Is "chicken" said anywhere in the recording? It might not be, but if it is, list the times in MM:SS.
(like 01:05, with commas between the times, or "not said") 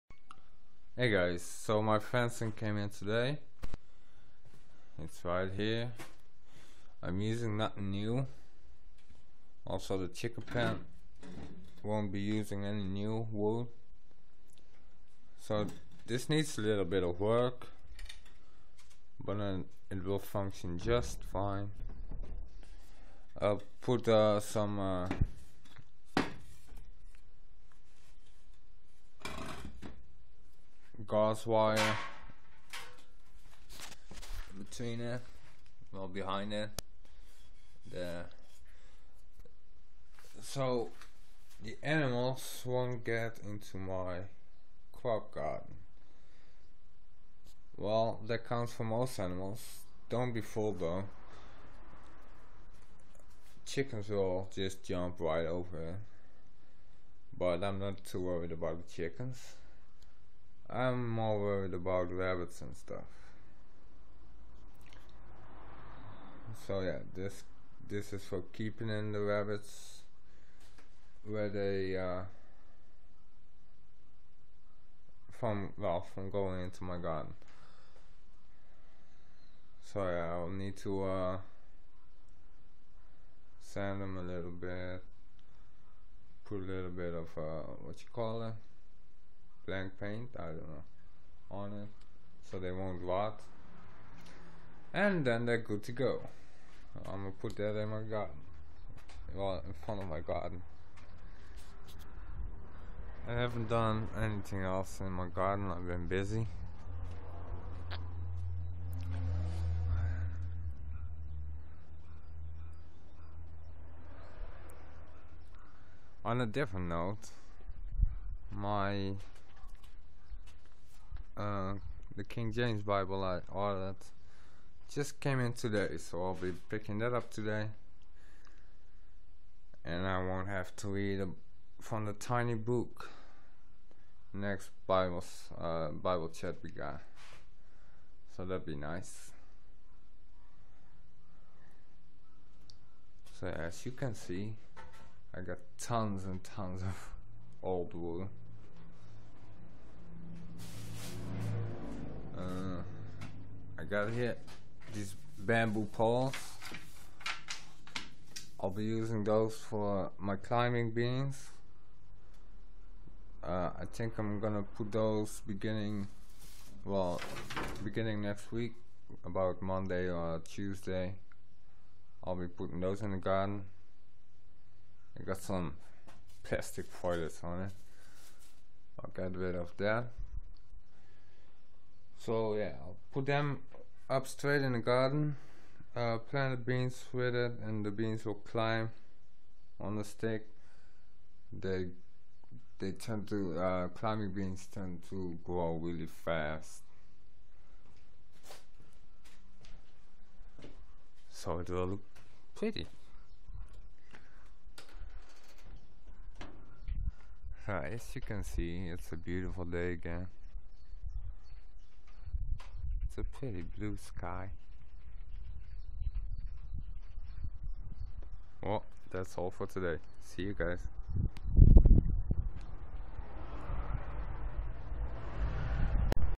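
00:10, 00:53, 00:58.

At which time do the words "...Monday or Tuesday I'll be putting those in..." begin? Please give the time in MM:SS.
02:49.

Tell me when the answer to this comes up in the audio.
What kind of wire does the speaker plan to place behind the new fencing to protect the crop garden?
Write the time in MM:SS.
00:31.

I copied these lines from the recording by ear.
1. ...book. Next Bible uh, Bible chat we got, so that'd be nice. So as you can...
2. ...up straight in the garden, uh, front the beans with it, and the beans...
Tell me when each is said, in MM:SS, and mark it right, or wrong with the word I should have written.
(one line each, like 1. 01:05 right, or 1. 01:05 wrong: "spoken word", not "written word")
1. 02:12 right
2. 03:04 wrong: "plant", not "front".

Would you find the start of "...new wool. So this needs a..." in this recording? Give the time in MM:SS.
00:12.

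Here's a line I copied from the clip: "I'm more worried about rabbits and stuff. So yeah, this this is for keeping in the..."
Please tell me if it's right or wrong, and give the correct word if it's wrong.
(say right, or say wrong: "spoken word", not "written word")
right.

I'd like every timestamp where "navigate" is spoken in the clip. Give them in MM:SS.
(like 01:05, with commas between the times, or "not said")
not said.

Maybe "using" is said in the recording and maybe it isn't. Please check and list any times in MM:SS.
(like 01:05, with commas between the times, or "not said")
00:07, 00:12, 02:38.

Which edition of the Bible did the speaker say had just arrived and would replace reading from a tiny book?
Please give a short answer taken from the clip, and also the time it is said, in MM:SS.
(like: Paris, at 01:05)
King James Bible, at 02:02.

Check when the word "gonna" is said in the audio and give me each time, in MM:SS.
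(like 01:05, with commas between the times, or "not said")
01:37, 02:44.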